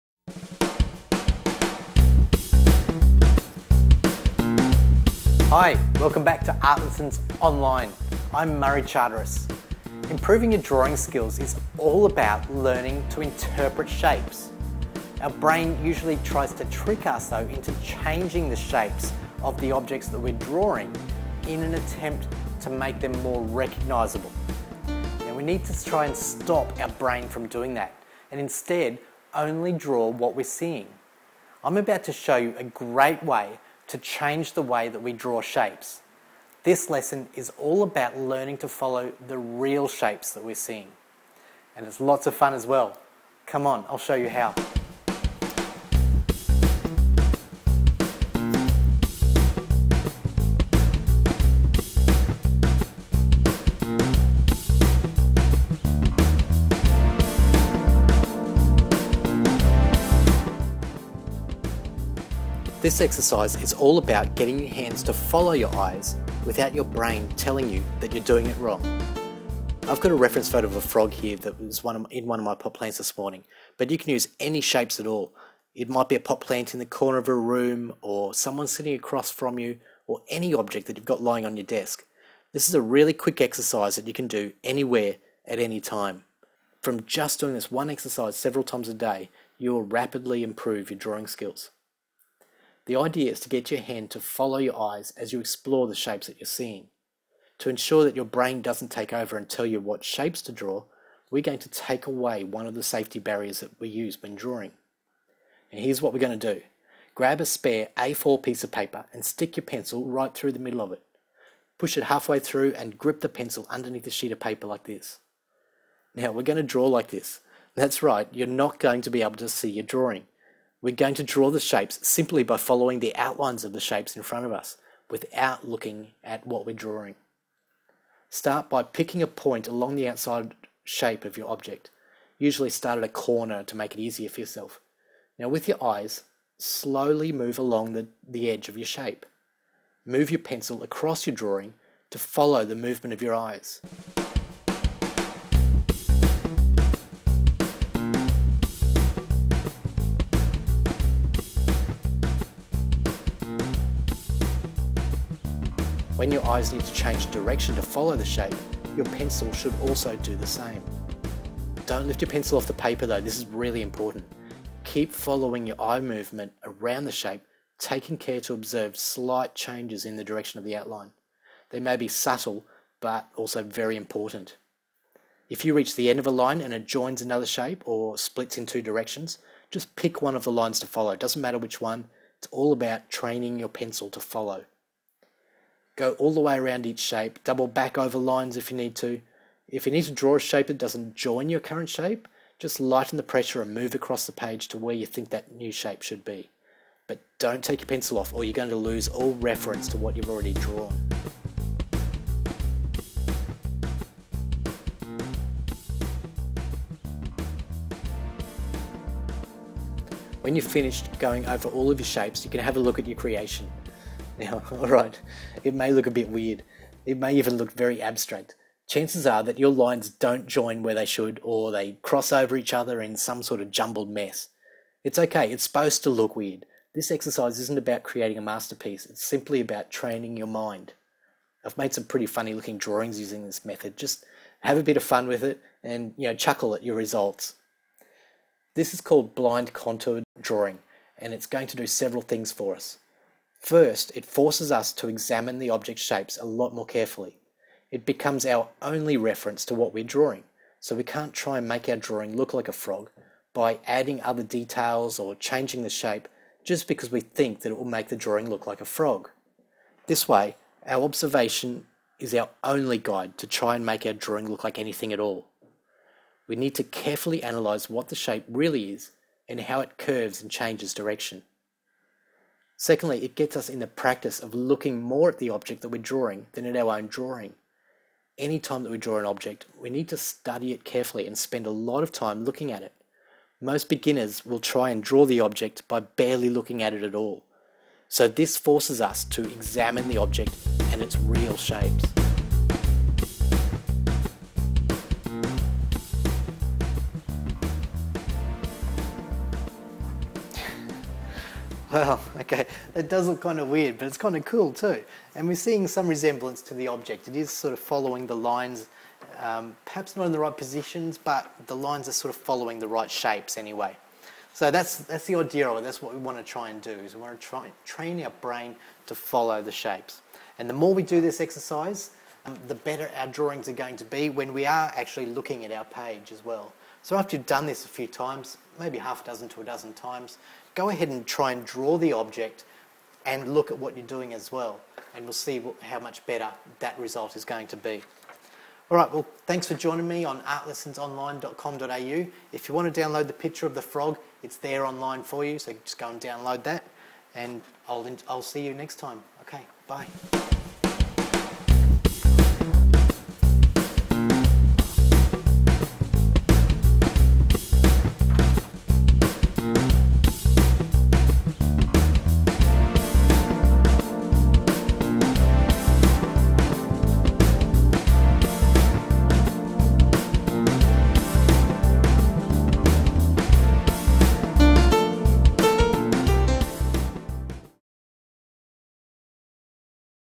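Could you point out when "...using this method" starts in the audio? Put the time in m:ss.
3:53.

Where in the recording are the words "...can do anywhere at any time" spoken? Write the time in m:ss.
1:24.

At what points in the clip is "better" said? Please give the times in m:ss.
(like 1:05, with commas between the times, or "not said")
5:22, 5:36.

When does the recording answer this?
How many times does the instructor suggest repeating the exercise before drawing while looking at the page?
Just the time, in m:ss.
5:28.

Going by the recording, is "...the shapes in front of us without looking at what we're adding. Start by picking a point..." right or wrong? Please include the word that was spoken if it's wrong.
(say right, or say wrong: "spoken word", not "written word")
wrong: "drawing", not "adding".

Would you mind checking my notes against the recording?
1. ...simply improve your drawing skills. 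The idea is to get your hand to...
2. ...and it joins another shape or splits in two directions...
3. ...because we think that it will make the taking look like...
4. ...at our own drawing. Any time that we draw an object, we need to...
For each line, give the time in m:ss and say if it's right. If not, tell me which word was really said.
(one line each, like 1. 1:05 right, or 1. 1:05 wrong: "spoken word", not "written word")
1. 1:29 wrong: "rapidly", not "simply"
2. 2:56 right
3. 4:16 wrong: "drawing", not "taking"
4. 4:36 right.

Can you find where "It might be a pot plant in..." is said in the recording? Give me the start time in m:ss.
1:15.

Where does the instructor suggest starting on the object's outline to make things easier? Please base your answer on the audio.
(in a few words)
At a corner.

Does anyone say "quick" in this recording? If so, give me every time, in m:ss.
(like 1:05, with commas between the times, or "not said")
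1:23.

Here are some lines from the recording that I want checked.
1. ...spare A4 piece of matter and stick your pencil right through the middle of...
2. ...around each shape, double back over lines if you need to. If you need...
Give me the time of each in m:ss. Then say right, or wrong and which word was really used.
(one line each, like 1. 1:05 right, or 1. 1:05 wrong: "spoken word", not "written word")
1. 1:47 wrong: "paper", not "matter"
2. 3:06 right.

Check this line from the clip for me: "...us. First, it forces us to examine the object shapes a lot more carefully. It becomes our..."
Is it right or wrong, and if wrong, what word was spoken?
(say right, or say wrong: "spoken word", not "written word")
right.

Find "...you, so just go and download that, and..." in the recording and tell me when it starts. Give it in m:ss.
5:45.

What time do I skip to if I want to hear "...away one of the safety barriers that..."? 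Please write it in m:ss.
1:42.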